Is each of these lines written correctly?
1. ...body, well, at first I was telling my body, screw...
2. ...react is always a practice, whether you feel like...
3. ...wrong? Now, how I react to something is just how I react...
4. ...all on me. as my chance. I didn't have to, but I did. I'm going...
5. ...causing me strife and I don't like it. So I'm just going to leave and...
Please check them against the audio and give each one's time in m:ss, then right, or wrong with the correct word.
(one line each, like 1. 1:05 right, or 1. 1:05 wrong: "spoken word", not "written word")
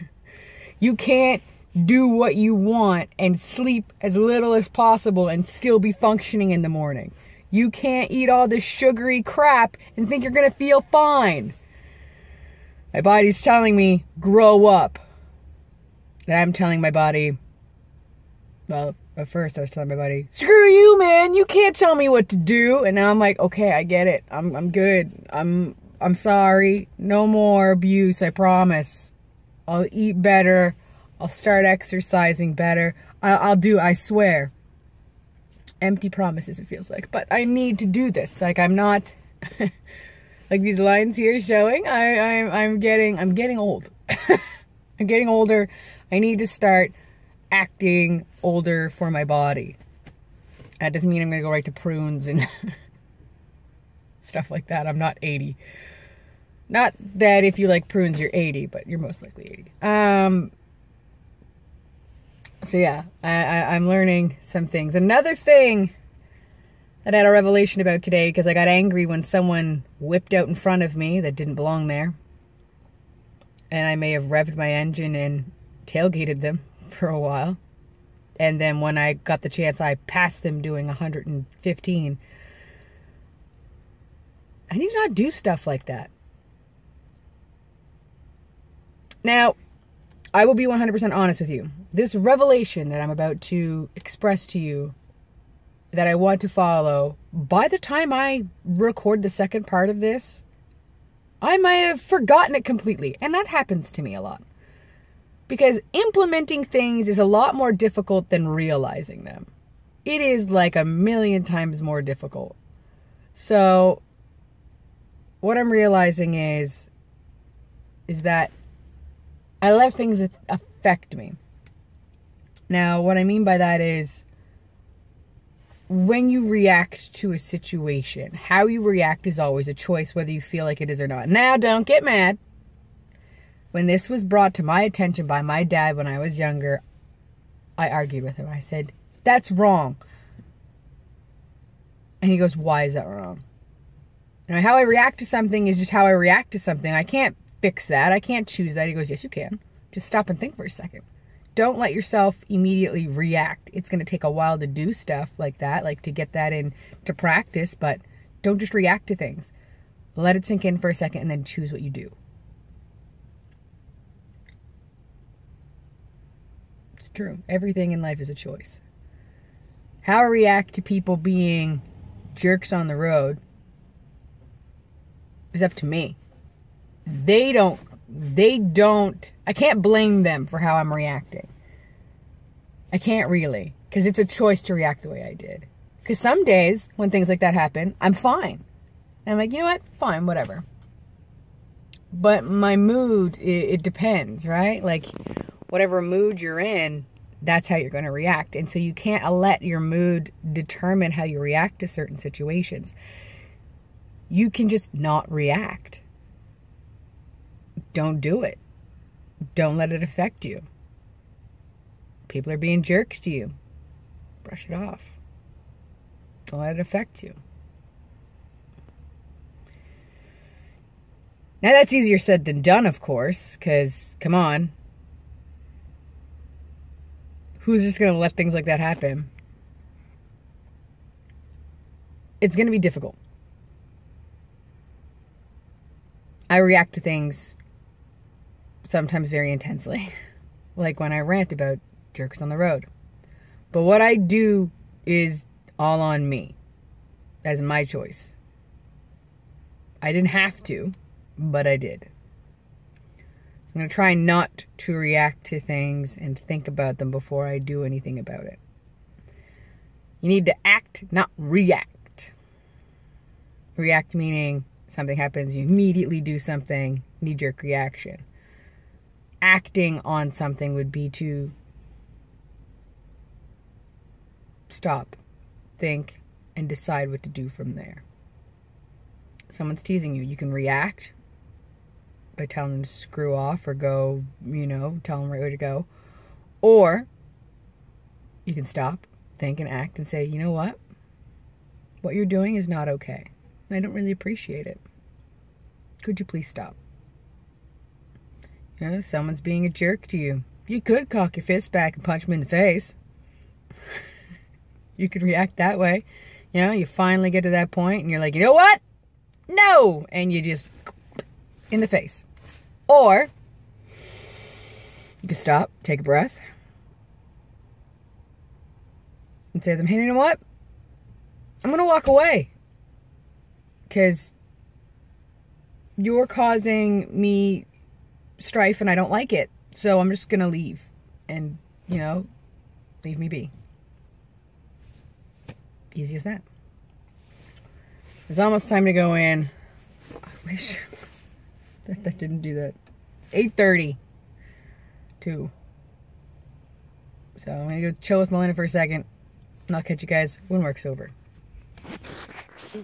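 1. 0:16 right
2. 2:08 wrong: "choice", not "practice"
3. 2:23 right
4. 4:05 wrong: "choice", not "chance"
5. 5:26 right.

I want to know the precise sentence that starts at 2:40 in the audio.
Let it sink in for a second and then choose what you do.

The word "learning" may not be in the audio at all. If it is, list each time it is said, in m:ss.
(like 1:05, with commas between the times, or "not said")
1:03.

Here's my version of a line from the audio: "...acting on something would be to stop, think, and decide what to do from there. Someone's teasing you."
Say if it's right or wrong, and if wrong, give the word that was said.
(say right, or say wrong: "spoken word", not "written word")
right.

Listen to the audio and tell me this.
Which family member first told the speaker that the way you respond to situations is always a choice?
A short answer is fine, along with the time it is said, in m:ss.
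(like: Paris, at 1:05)
dad, at 2:15.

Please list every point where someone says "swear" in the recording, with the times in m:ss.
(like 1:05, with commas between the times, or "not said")
0:33.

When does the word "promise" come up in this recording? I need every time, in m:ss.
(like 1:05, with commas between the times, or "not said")
0:28, 0:36.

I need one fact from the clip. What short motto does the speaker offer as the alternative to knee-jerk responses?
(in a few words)
act, not react.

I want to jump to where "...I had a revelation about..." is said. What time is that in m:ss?
1:07.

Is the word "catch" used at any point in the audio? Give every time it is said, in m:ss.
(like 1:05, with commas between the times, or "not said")
5:49.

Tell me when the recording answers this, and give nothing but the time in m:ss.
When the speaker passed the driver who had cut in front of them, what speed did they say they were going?
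1:20.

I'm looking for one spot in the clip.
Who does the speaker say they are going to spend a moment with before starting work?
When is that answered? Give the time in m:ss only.
5:48.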